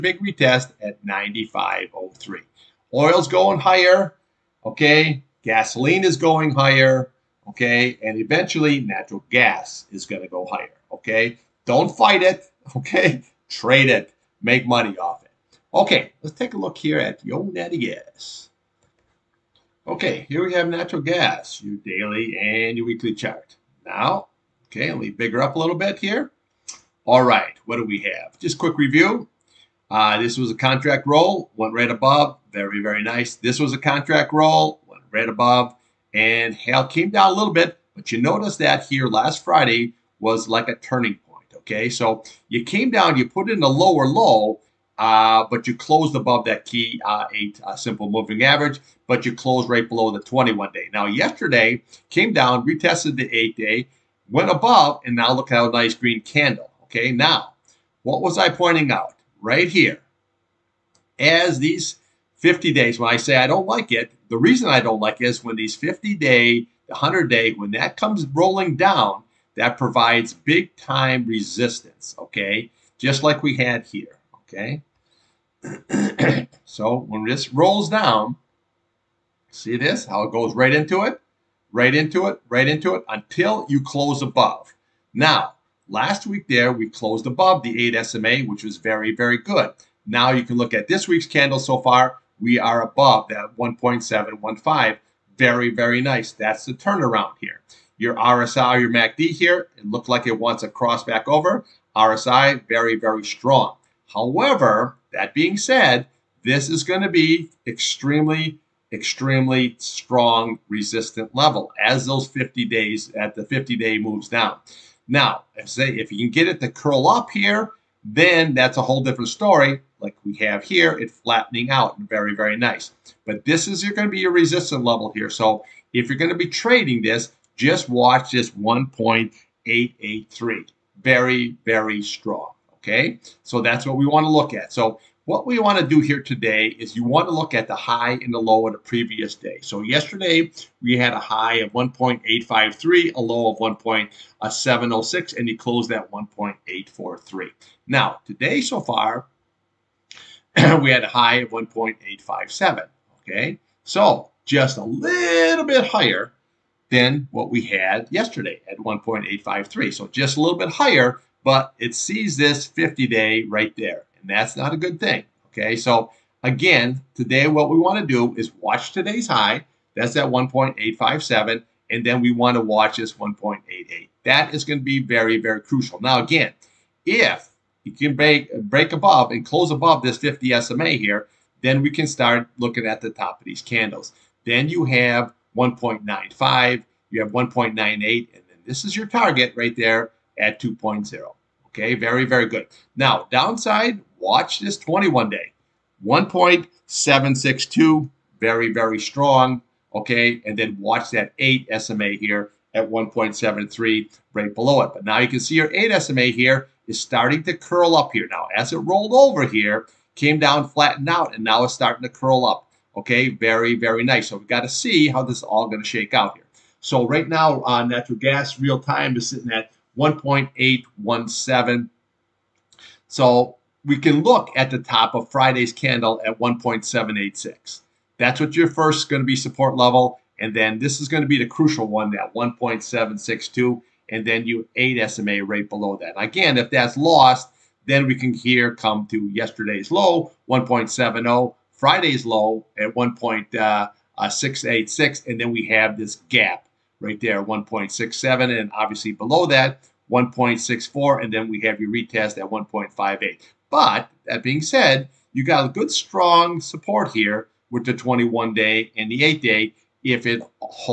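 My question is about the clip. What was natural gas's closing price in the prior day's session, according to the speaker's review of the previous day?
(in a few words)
1.843.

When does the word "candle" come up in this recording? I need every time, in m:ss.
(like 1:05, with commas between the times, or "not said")
0:56, 1:31, 3:03, 3:45.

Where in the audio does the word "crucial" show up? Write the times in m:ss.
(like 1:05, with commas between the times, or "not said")
2:55, 3:51.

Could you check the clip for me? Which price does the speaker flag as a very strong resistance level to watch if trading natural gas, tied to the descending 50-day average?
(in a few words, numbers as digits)
1.883.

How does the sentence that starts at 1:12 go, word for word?
Just like we had here, okay?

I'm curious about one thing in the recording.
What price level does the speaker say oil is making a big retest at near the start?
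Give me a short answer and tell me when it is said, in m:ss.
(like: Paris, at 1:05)
95.03, at 0:01.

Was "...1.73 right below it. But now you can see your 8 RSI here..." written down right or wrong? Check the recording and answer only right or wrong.
wrong.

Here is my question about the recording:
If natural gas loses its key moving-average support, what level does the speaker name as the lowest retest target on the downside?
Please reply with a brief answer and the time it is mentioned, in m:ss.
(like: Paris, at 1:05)
1.58, at 4:12.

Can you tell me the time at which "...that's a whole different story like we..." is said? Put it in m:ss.
1:58.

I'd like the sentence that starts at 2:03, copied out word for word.
But this is going to be your resistance level here.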